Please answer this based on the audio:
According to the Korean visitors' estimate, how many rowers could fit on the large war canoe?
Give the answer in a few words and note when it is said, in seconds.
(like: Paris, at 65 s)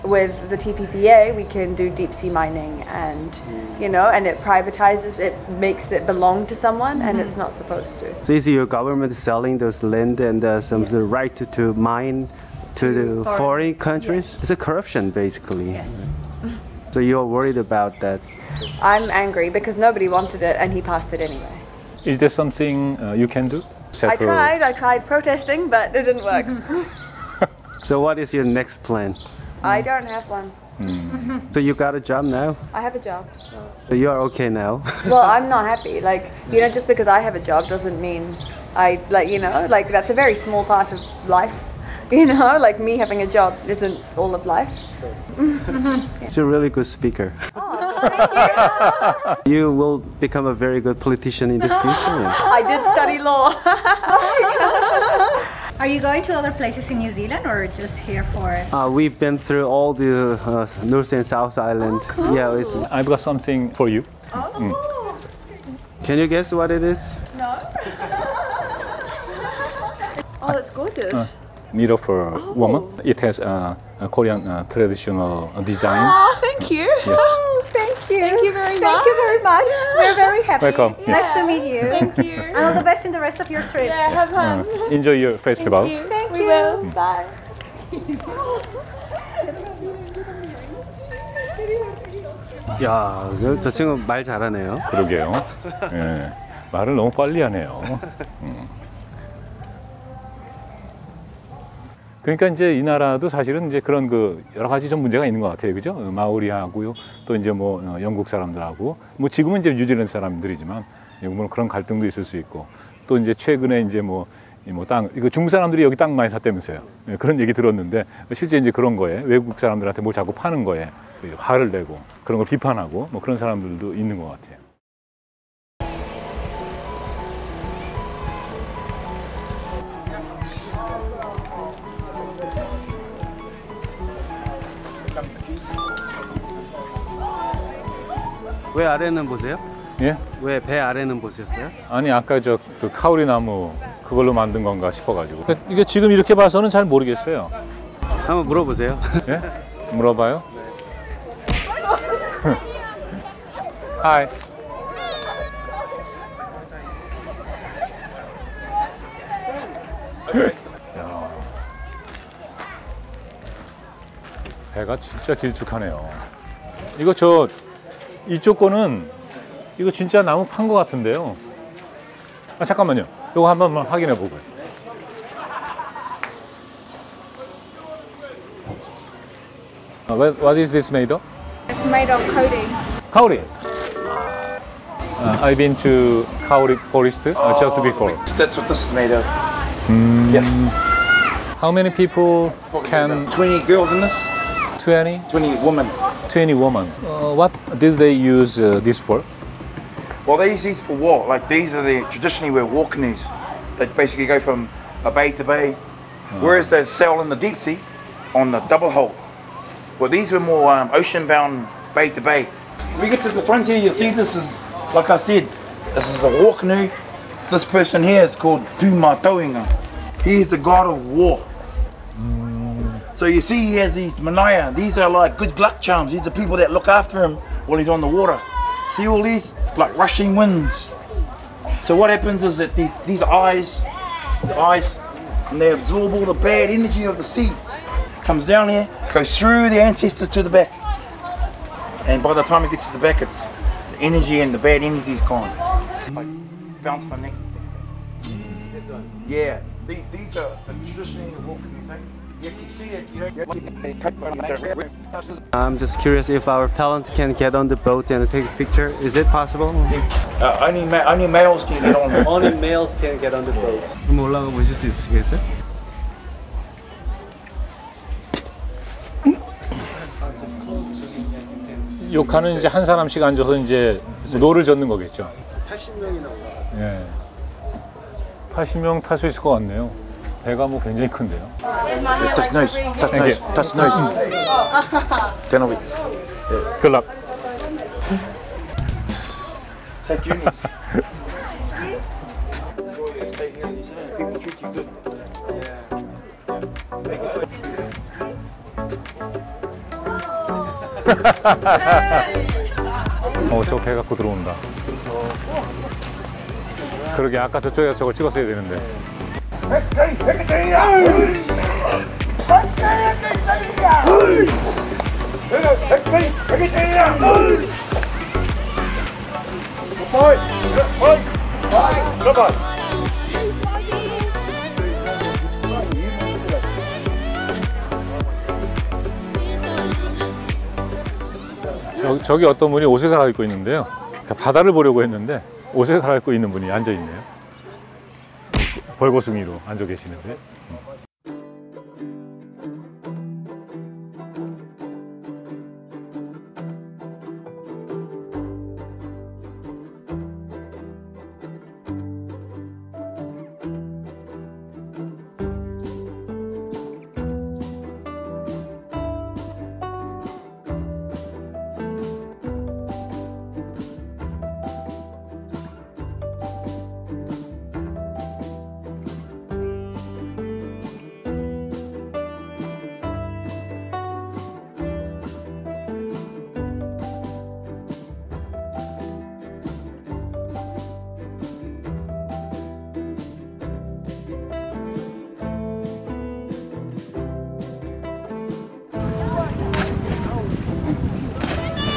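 80, at 278 s.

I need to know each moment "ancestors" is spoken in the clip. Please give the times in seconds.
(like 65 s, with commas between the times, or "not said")
239 s.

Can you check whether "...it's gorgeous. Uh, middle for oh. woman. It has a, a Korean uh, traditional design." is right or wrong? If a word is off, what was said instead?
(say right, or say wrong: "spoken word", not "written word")
right.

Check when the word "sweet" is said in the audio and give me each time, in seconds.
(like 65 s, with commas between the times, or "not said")
not said.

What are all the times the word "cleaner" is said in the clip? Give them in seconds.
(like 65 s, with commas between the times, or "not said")
not said.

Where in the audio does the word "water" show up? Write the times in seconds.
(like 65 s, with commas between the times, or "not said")
228 s.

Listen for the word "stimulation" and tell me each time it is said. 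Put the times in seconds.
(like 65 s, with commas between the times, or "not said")
not said.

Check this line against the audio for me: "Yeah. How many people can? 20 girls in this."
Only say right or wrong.
right.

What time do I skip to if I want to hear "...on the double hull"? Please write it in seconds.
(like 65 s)
208 s.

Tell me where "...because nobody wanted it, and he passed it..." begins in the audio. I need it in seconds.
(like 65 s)
19 s.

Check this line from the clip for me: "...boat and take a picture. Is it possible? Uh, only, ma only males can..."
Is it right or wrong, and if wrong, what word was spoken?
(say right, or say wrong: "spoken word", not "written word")
right.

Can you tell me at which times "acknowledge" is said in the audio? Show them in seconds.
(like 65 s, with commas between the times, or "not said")
not said.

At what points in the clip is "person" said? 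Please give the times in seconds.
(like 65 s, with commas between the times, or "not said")
217 s.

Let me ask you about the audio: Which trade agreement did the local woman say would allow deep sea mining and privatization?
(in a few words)
TPPA.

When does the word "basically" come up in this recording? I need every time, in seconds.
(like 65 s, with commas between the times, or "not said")
15 s, 203 s.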